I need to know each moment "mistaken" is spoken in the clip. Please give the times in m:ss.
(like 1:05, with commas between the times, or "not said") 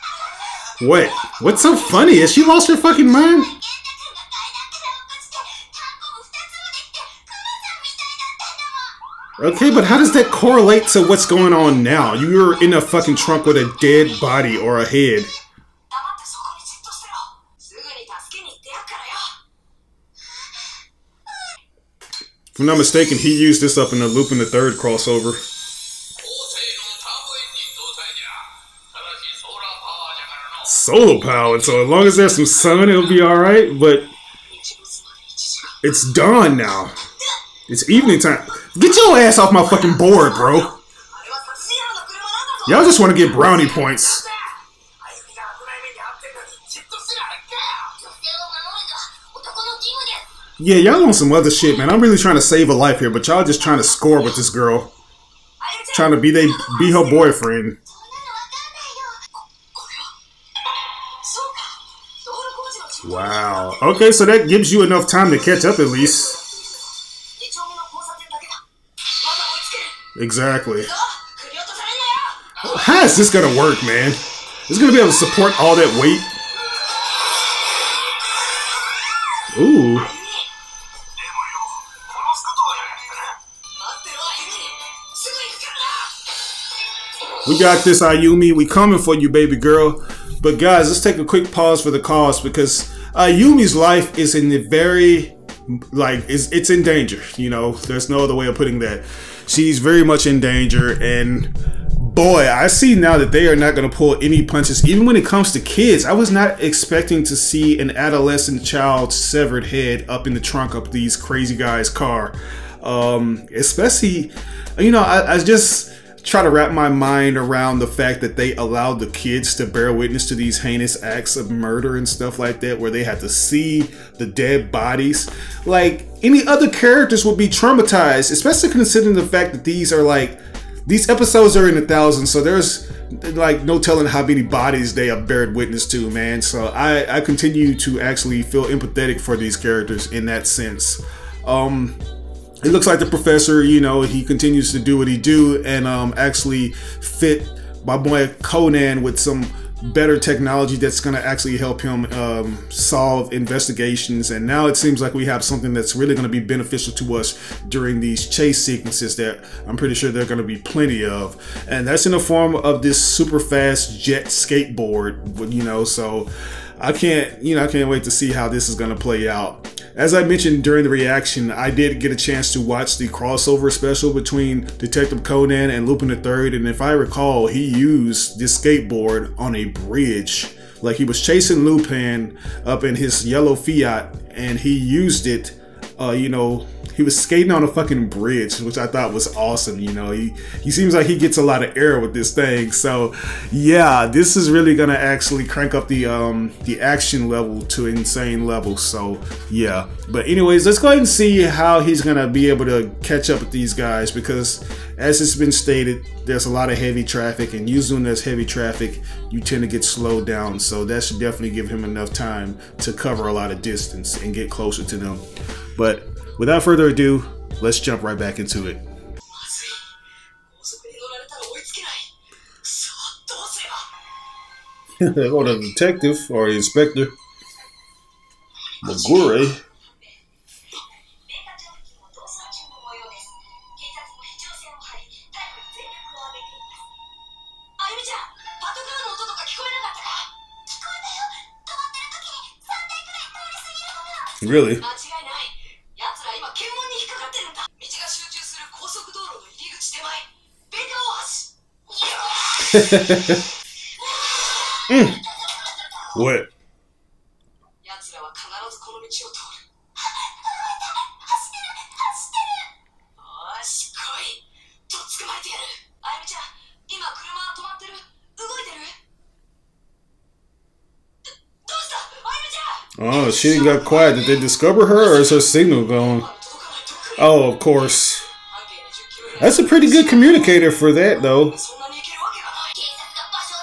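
0:22.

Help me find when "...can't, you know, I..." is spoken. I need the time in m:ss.
2:46.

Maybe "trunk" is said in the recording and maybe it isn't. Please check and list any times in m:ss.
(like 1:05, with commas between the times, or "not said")
0:13, 1:50.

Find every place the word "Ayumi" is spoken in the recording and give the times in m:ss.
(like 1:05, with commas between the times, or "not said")
1:28, 1:33.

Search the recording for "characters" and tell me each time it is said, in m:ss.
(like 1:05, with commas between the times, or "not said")
2:06, 2:19.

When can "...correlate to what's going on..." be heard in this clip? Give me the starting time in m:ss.
0:10.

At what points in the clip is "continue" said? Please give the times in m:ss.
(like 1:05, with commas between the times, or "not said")
2:17, 2:24.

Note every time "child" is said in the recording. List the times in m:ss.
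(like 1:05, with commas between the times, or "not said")
1:48.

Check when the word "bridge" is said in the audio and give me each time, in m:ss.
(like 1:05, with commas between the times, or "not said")
2:59, 3:08.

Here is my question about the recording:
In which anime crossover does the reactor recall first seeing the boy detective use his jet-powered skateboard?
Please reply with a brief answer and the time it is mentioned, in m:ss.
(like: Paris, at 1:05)
Lupin the third, at 0:24.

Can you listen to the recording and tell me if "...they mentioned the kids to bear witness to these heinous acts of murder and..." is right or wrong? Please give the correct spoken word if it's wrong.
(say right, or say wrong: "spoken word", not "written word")
wrong: "allowed", not "mentioned".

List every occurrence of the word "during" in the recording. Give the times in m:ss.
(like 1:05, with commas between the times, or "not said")
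2:37, 2:50.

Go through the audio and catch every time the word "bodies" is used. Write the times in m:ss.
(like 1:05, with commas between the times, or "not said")
2:04, 2:14.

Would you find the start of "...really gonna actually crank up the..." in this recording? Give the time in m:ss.
3:14.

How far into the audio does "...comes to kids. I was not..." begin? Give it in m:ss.
1:45.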